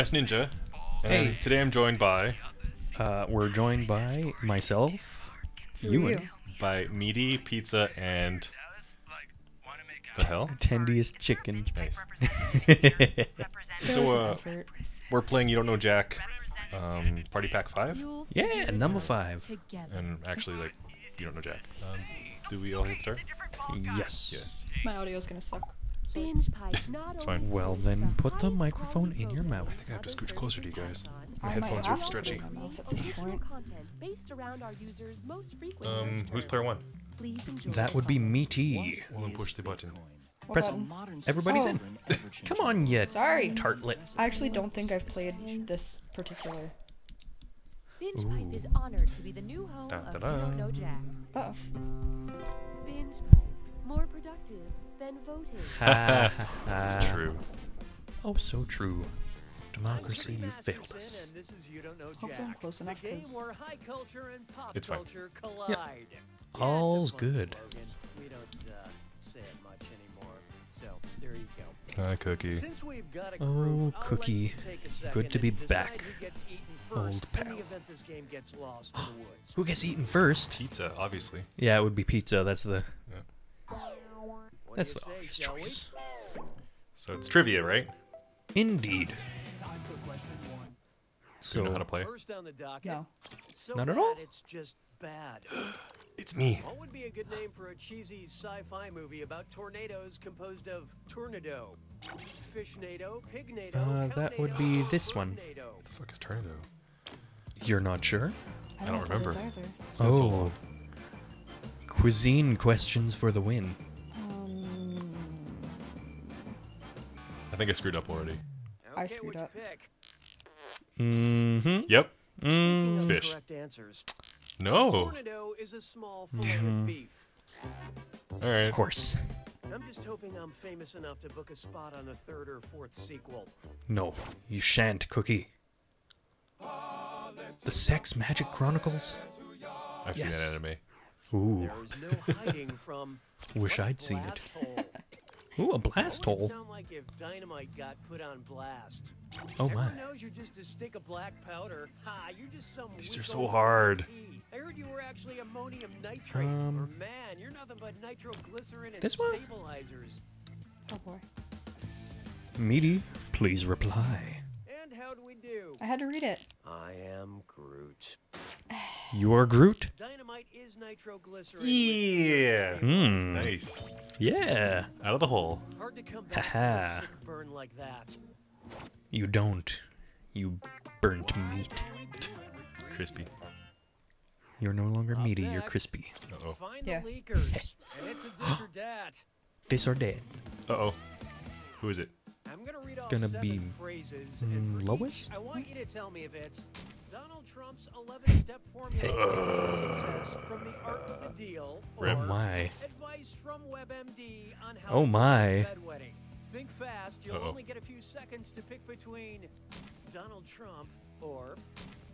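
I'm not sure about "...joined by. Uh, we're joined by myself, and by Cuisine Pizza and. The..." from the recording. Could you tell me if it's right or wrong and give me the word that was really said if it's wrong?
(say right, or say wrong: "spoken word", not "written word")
wrong: "Meaty", not "Cuisine".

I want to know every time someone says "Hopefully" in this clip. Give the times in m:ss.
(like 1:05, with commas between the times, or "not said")
1:02.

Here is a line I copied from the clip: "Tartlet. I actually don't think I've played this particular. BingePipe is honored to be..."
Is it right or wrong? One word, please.
right.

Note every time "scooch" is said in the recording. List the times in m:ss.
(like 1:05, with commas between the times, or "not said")
0:30.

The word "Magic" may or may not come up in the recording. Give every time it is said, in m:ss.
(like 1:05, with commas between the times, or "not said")
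2:18.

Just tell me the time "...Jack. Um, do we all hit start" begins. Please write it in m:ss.
0:21.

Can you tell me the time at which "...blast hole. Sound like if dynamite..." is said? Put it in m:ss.
2:25.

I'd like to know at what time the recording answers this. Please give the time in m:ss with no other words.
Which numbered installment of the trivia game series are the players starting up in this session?
0:17.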